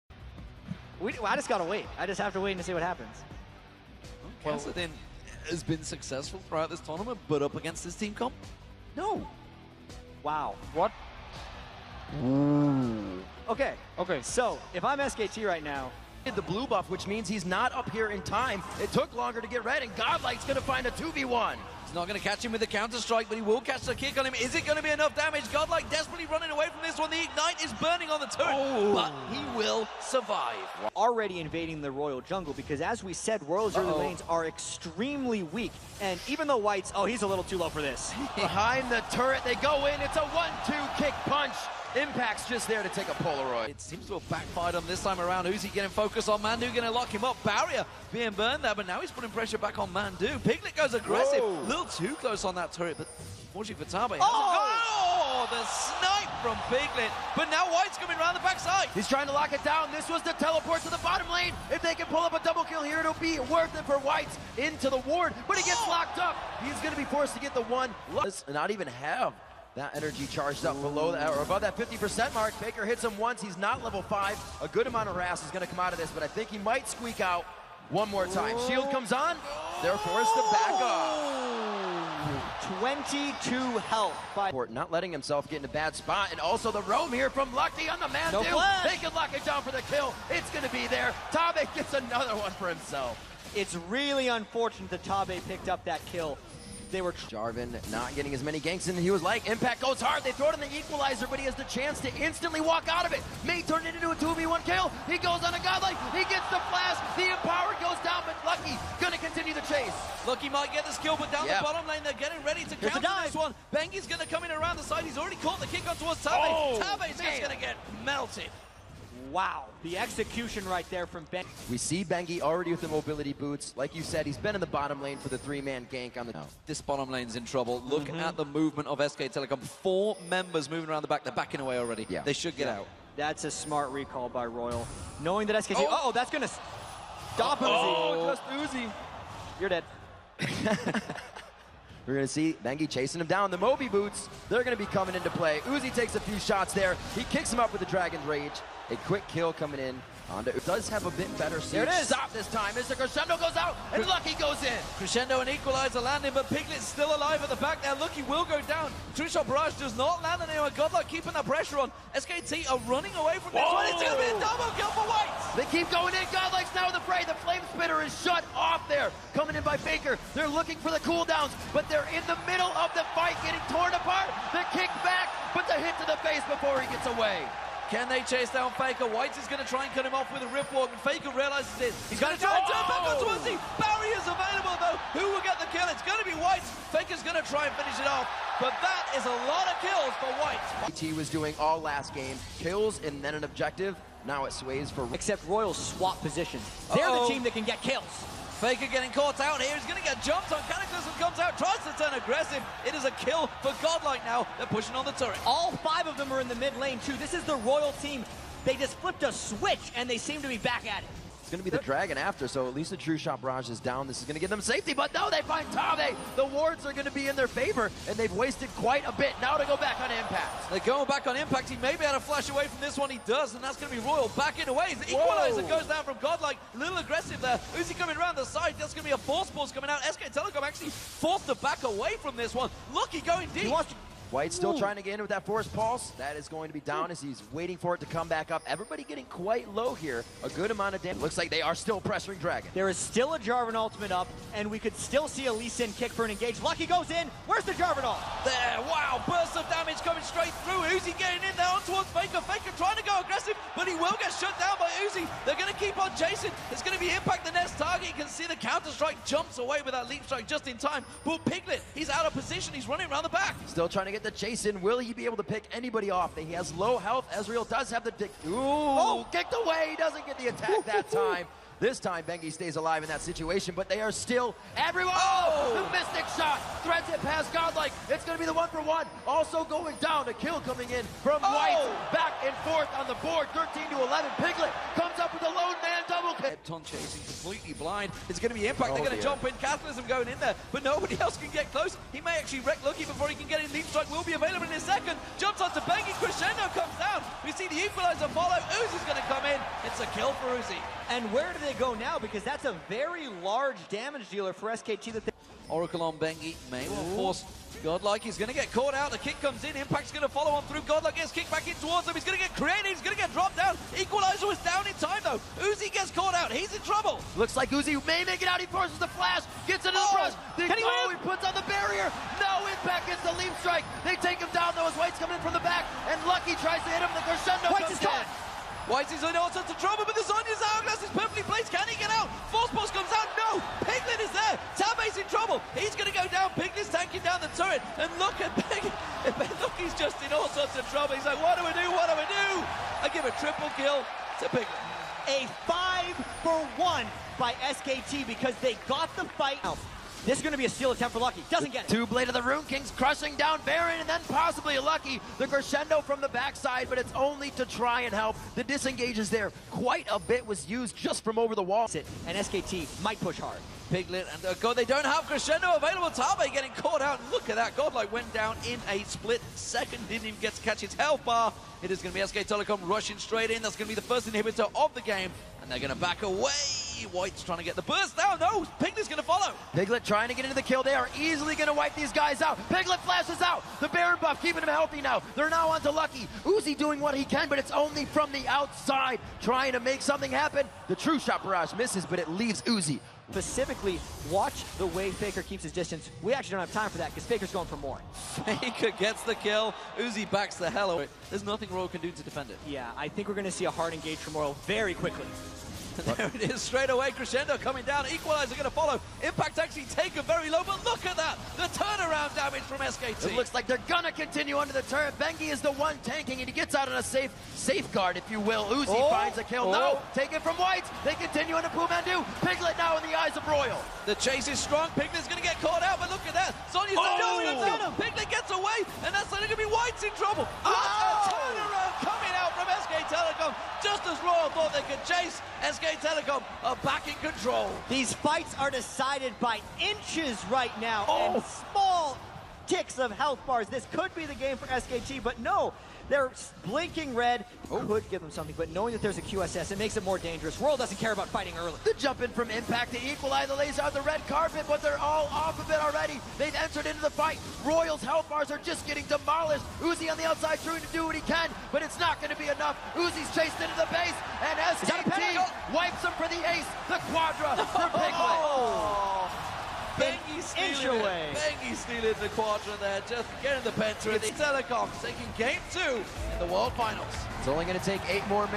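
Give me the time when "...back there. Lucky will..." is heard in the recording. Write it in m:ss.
2:37.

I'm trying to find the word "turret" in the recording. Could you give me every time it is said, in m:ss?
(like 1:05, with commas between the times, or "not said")
0:28, 0:39, 0:52, 3:25, 5:37, 6:54.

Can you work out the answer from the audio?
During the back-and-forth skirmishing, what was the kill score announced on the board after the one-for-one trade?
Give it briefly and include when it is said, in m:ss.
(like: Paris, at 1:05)
13 11, at 4:43.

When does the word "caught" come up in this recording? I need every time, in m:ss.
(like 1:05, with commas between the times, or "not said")
1:55, 3:19, 5:08, 5:16, 5:28, 6:06, 7:05.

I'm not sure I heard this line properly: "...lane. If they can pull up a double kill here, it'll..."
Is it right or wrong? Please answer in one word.
right.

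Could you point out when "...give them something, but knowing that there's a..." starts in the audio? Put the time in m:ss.
7:28.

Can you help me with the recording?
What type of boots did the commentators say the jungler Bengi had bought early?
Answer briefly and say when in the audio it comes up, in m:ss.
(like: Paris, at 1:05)
Mobility boots, at 2:02.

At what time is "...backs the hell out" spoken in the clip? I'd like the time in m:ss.
6:40.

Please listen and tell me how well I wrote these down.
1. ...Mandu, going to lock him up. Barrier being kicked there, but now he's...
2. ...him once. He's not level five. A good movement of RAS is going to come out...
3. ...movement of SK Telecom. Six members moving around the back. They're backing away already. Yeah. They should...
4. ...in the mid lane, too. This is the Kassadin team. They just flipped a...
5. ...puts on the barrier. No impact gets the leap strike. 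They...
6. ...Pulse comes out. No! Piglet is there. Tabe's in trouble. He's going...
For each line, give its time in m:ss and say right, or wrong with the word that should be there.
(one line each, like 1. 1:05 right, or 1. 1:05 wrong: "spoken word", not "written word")
1. 0:46 wrong: "burned", not "kicked"
2. 1:13 wrong: "amount", not "movement"
3. 2:08 wrong: "Four", not "Six"
4. 3:26 wrong: "Royal", not "Kassadin"
5. 5:21 right
6. 5:32 right.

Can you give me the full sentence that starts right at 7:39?
Uzi on the outside trying to do what he can, but it's not going to be enough.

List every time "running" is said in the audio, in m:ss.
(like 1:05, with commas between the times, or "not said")
0:26, 2:42, 4:22.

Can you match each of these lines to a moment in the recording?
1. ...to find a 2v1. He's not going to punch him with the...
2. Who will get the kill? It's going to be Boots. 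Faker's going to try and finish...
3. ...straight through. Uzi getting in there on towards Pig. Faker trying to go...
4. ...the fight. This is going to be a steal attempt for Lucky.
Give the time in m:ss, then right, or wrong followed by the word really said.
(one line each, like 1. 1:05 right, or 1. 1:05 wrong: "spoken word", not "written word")
1. 0:20 wrong: "catch", not "punch"
2. 3:05 wrong: "White", not "Boots"
3. 4:10 wrong: "Faker", not "Pig"
4. 5:49 right.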